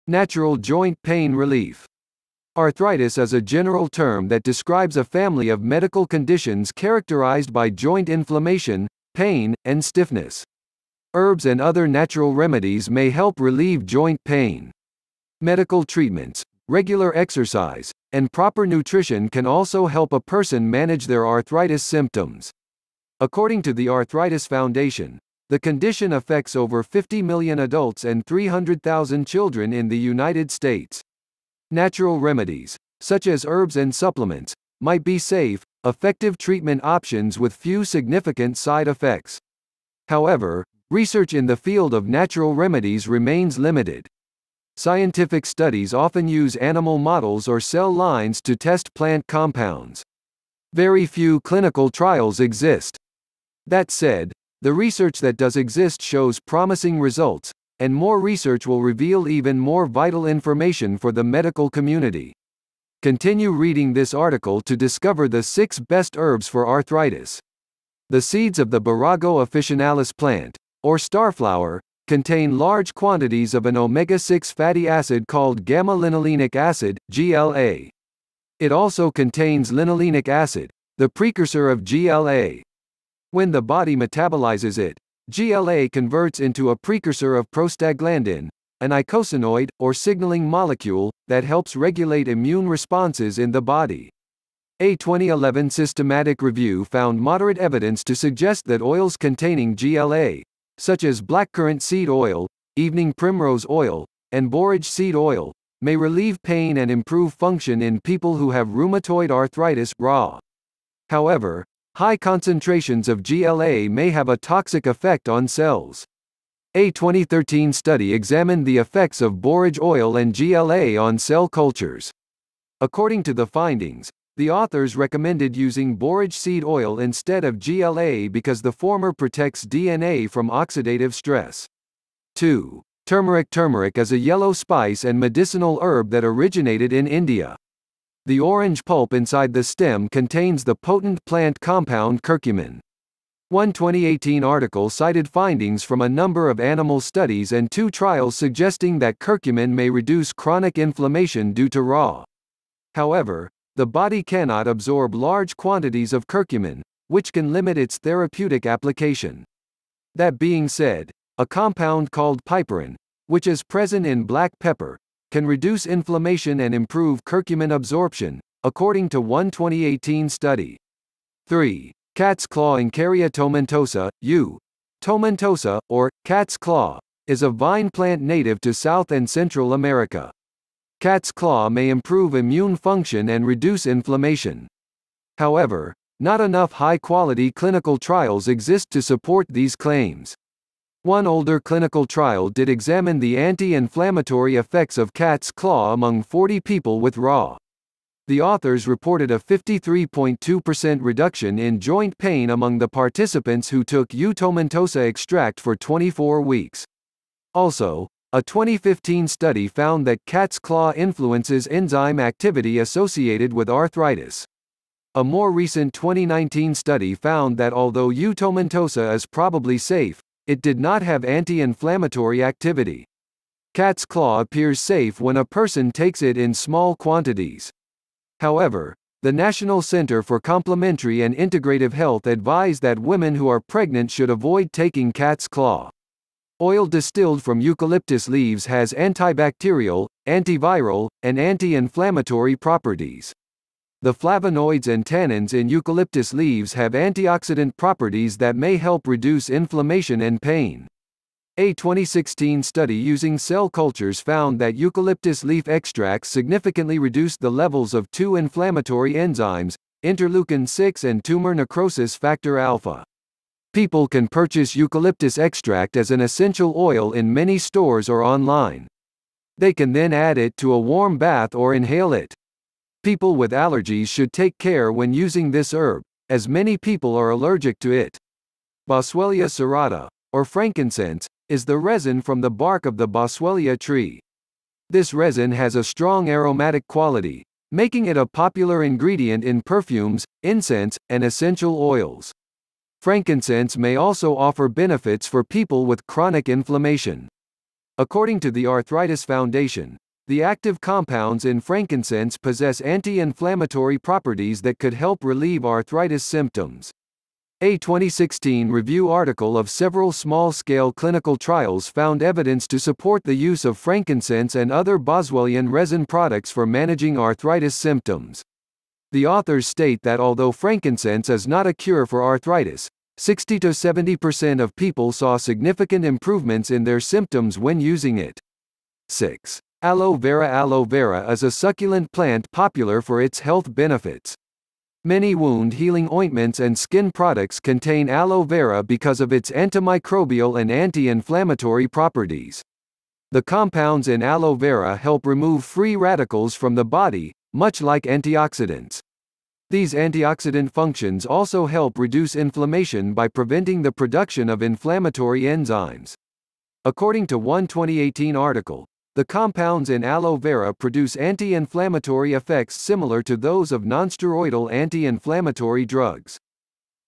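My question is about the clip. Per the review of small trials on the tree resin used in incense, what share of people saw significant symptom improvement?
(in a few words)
60 to 70%.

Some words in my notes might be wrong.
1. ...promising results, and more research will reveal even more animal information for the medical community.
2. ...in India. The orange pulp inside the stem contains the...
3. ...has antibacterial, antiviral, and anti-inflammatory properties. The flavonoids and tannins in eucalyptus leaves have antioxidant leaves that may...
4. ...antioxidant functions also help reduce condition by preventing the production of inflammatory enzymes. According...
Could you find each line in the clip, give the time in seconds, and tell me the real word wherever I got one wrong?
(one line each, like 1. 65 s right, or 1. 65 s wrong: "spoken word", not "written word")
1. 56 s wrong: "vital", not "animal"
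2. 136 s right
3. 238 s wrong: "properties", not "leaves"
4. 349 s wrong: "inflammation", not "condition".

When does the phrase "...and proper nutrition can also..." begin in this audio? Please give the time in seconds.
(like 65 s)
18 s.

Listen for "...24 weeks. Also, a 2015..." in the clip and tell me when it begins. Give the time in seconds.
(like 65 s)
205 s.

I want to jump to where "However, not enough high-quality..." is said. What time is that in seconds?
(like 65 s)
185 s.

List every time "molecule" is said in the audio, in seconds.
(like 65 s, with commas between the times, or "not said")
90 s.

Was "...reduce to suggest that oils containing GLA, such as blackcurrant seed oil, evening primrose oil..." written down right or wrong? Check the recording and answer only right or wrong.
wrong.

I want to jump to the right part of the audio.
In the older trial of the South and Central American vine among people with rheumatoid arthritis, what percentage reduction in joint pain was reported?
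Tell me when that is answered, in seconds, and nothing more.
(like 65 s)
199 s.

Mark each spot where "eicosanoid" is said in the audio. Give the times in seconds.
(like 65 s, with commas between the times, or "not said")
88 s.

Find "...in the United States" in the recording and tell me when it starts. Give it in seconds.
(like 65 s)
29 s.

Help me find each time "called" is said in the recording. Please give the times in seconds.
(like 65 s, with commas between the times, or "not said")
75 s, 162 s.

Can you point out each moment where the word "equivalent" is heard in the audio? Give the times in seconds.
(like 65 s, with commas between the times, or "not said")
not said.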